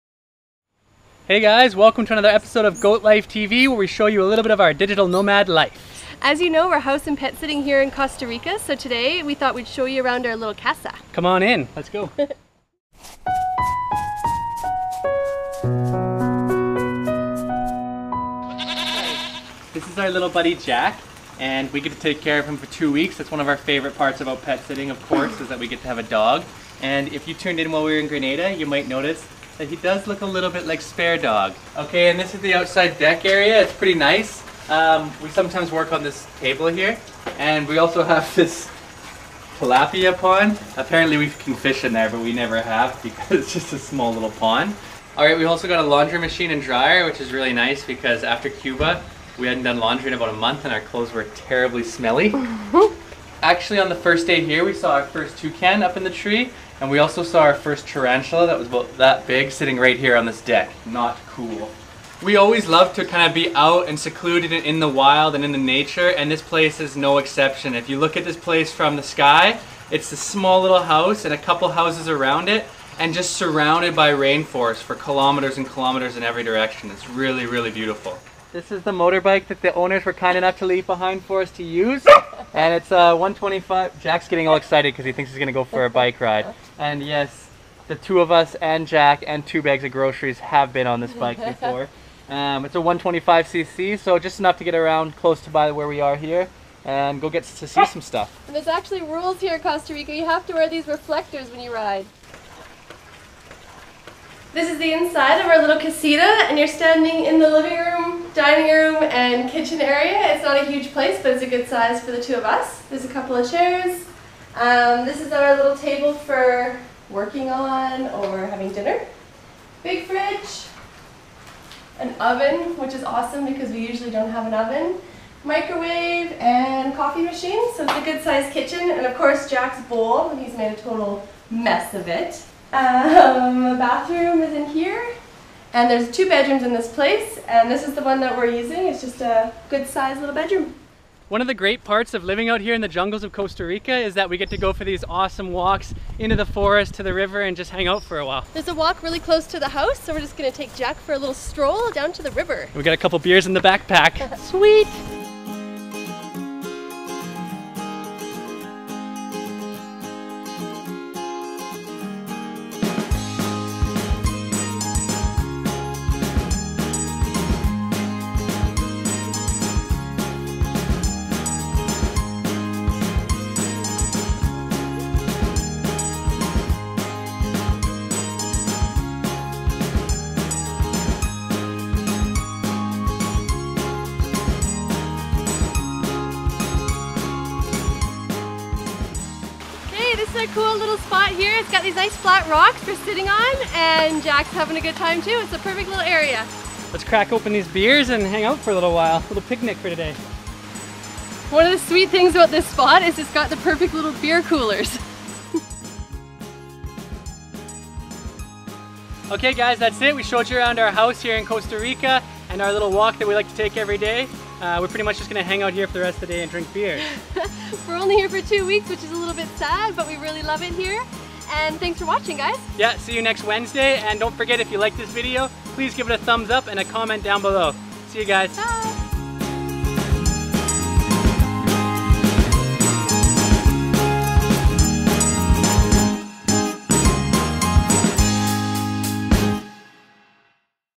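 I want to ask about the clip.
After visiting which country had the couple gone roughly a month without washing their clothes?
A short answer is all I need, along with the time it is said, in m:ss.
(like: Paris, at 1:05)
Cuba, at 0:48.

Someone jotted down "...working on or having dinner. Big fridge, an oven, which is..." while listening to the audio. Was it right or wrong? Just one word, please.
right.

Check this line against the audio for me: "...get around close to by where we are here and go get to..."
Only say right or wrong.
right.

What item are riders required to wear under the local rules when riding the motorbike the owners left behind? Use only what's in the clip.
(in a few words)
Reflectors.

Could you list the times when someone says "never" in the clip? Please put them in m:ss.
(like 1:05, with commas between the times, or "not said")
0:42.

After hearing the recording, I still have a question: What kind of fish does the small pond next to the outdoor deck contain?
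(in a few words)
Tilapia.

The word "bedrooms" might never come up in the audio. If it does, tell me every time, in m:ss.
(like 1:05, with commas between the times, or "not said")
2:16, 2:20.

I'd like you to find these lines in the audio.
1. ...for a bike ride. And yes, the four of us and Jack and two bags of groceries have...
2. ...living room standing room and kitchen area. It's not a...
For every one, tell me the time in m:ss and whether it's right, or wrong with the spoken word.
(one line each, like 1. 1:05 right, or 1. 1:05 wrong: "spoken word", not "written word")
1. 1:25 wrong: "two", not "four"
2. 1:47 wrong: "dining", not "standing".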